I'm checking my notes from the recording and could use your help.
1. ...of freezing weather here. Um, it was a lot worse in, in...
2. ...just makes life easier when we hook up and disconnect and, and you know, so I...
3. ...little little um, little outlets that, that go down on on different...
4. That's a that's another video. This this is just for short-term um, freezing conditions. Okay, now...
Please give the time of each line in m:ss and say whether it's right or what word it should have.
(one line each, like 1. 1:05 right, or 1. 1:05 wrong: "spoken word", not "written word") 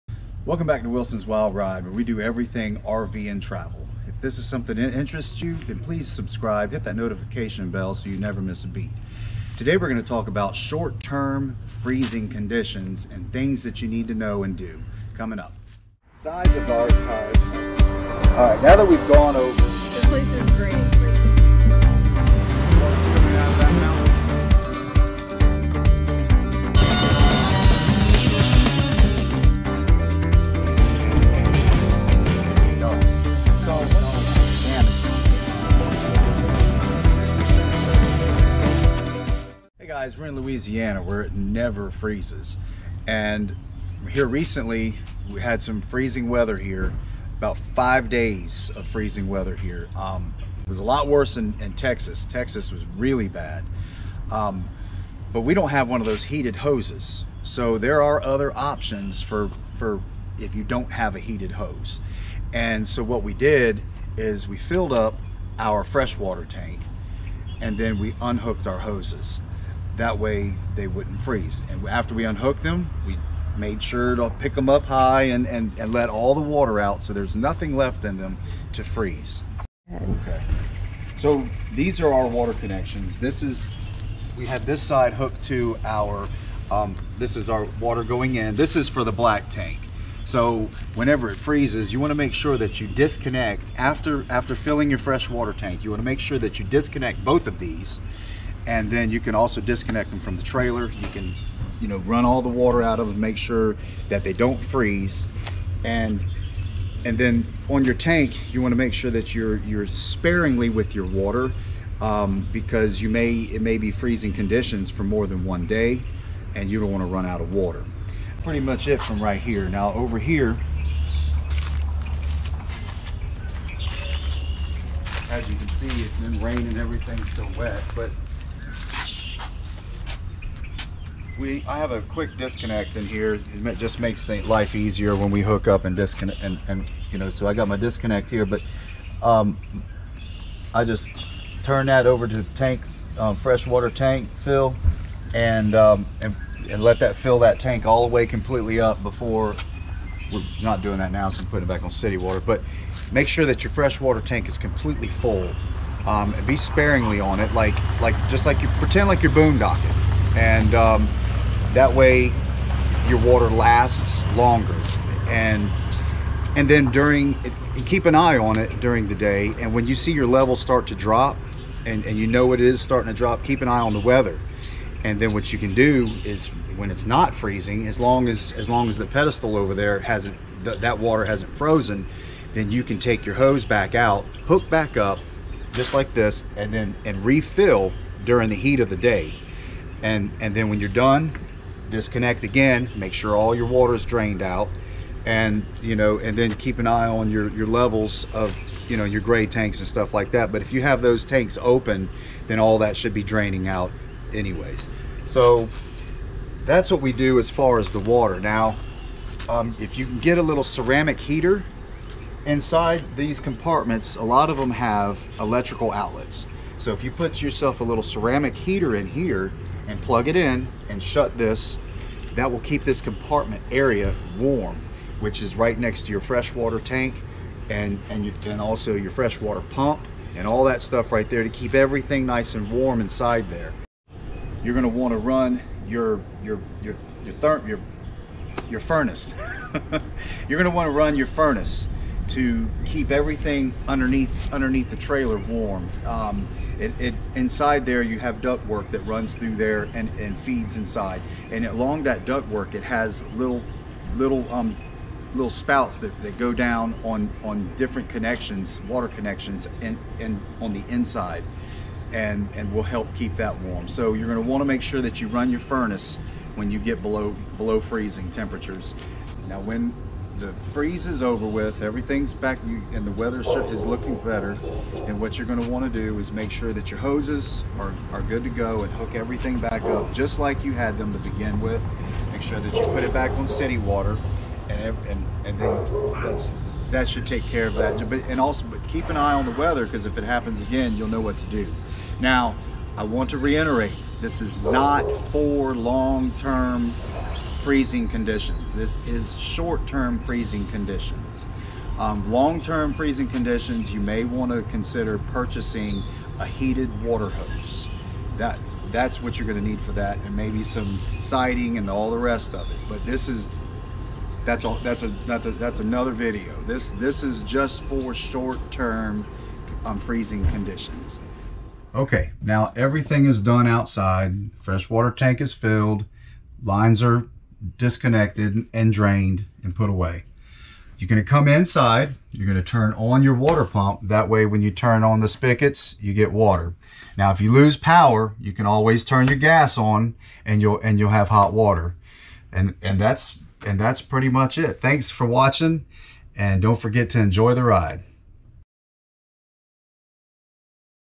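1. 0:48 right
2. 2:13 right
3. 4:13 wrong: "spouts", not "outlets"
4. 5:14 right.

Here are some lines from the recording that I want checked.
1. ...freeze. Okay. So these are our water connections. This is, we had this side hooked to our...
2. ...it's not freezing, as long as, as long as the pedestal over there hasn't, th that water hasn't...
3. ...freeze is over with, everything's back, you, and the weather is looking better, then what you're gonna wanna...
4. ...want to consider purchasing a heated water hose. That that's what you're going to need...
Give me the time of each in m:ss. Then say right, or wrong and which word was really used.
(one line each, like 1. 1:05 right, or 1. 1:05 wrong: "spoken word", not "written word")
1. 1:18 right
2. 2:56 right
3. 4:30 right
4. 5:04 right.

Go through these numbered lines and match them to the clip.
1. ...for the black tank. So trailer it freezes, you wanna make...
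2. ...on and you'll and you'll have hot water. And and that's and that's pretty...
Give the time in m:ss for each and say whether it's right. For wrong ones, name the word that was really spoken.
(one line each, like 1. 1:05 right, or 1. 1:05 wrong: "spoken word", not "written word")
1. 1:28 wrong: "whenever", not "trailer"
2. 5:39 right.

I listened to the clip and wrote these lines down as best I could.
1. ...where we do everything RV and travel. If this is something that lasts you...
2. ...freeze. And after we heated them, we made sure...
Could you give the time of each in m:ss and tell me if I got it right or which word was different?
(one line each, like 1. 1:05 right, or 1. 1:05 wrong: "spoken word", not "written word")
1. 0:01 wrong: "interests", not "lasts"
2. 1:11 wrong: "unhooked", not "heated".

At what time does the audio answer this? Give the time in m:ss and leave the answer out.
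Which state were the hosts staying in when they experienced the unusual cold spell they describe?
0:40.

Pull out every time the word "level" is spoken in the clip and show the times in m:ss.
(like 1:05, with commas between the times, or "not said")
2:50, 3:17.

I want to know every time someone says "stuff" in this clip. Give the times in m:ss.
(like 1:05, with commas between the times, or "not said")
3:19, 3:50.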